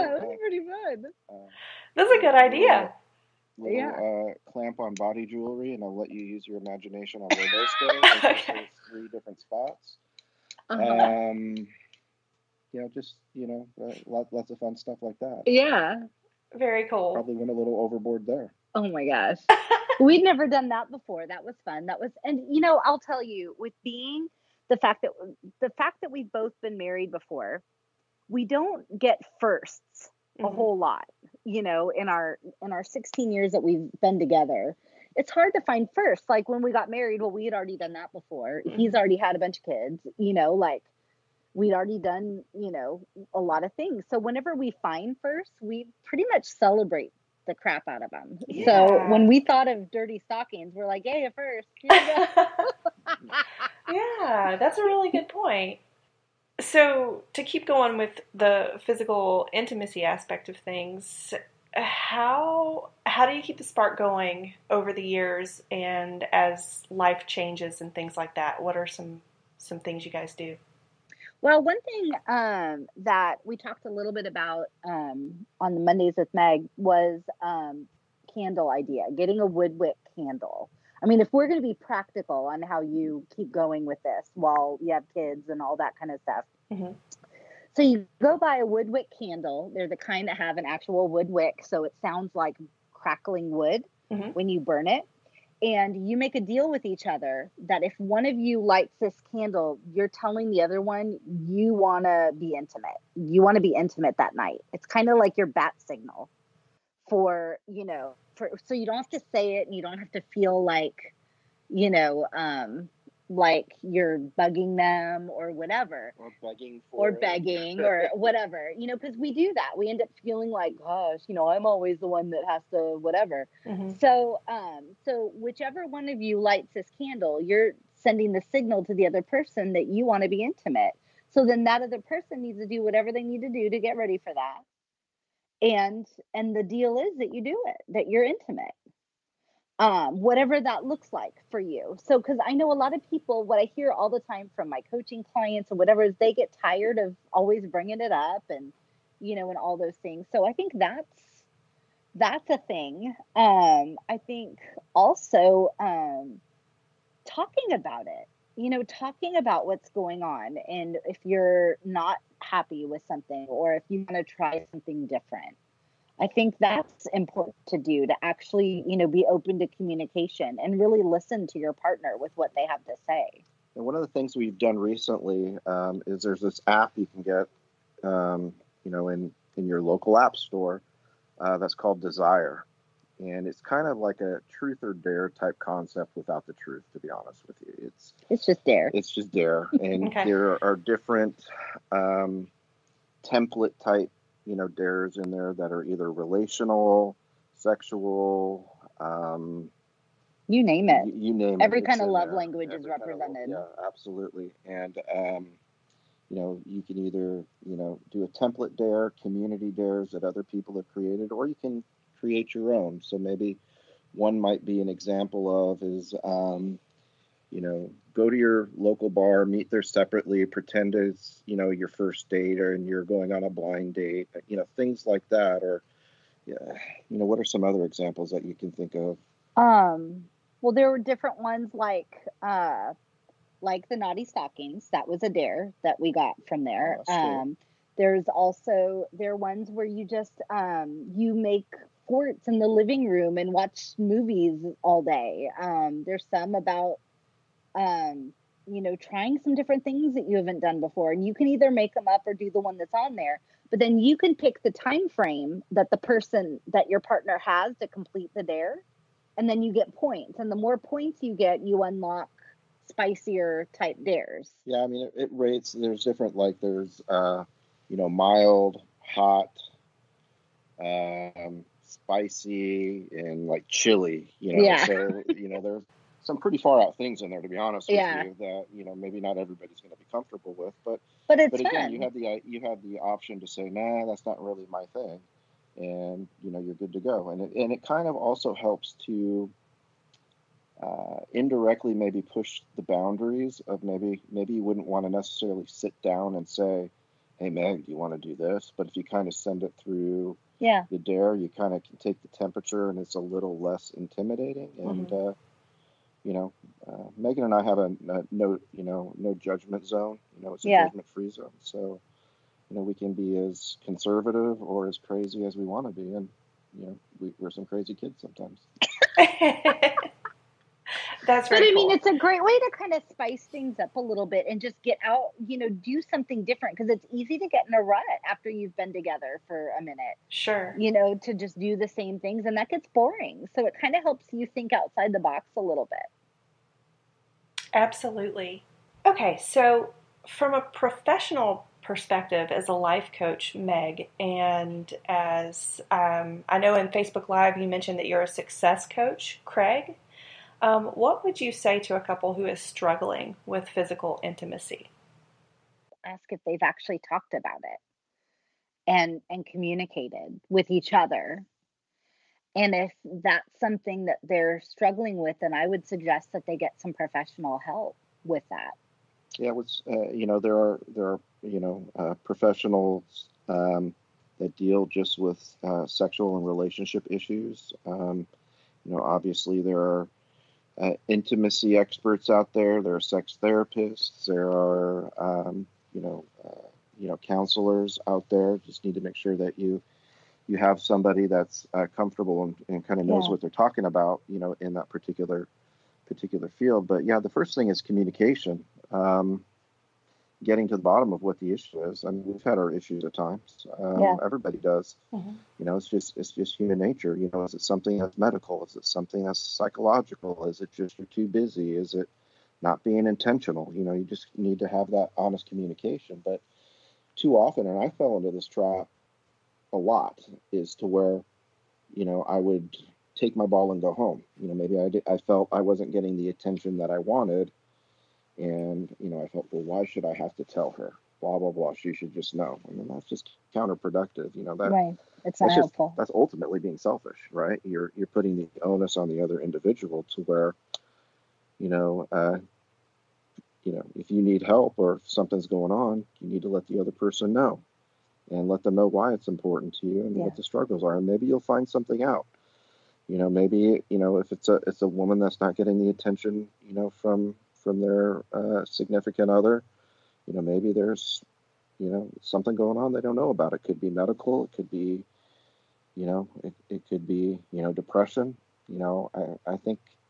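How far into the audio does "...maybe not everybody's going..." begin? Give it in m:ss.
4:38.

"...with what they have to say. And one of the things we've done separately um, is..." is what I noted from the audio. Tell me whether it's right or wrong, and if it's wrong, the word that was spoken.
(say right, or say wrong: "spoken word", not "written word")
wrong: "recently", not "separately".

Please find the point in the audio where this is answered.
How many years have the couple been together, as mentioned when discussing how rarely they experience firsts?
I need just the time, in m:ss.
0:32.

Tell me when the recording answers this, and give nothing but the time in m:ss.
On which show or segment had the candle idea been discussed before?
1:15.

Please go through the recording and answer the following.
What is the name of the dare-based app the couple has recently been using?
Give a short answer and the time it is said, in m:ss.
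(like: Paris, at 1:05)
Desire, at 3:02.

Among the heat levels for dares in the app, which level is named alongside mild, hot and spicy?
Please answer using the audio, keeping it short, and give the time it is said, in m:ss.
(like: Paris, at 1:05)
Chili, at 4:33.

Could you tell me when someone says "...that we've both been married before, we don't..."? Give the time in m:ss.
0:26.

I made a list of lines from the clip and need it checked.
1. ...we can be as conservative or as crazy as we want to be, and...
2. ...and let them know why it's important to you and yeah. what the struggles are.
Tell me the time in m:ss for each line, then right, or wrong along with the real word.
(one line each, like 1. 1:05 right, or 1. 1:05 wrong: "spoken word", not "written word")
1. 5:12 right
2. 7:28 right.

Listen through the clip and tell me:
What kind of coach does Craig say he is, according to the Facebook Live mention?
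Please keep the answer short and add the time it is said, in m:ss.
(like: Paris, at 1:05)
Success coach, at 5:48.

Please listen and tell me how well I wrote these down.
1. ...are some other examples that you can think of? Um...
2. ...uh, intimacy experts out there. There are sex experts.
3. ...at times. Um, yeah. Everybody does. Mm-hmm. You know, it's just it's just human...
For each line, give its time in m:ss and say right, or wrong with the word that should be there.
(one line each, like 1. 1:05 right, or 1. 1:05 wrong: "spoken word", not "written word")
1. 3:47 right
2. 6:20 wrong: "therapists", not "experts"
3. 6:43 right.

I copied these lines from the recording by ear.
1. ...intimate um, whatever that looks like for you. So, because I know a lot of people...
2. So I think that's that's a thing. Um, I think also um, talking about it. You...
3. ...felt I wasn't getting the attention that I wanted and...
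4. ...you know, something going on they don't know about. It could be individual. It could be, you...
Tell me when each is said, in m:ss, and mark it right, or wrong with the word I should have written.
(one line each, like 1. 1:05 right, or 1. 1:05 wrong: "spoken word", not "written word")
1. 2:18 right
2. 2:30 right
3. 7:05 right
4. 7:41 wrong: "medical", not "individual".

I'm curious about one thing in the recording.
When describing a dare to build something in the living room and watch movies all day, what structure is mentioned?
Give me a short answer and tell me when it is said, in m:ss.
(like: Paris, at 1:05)
Forts, at 4:02.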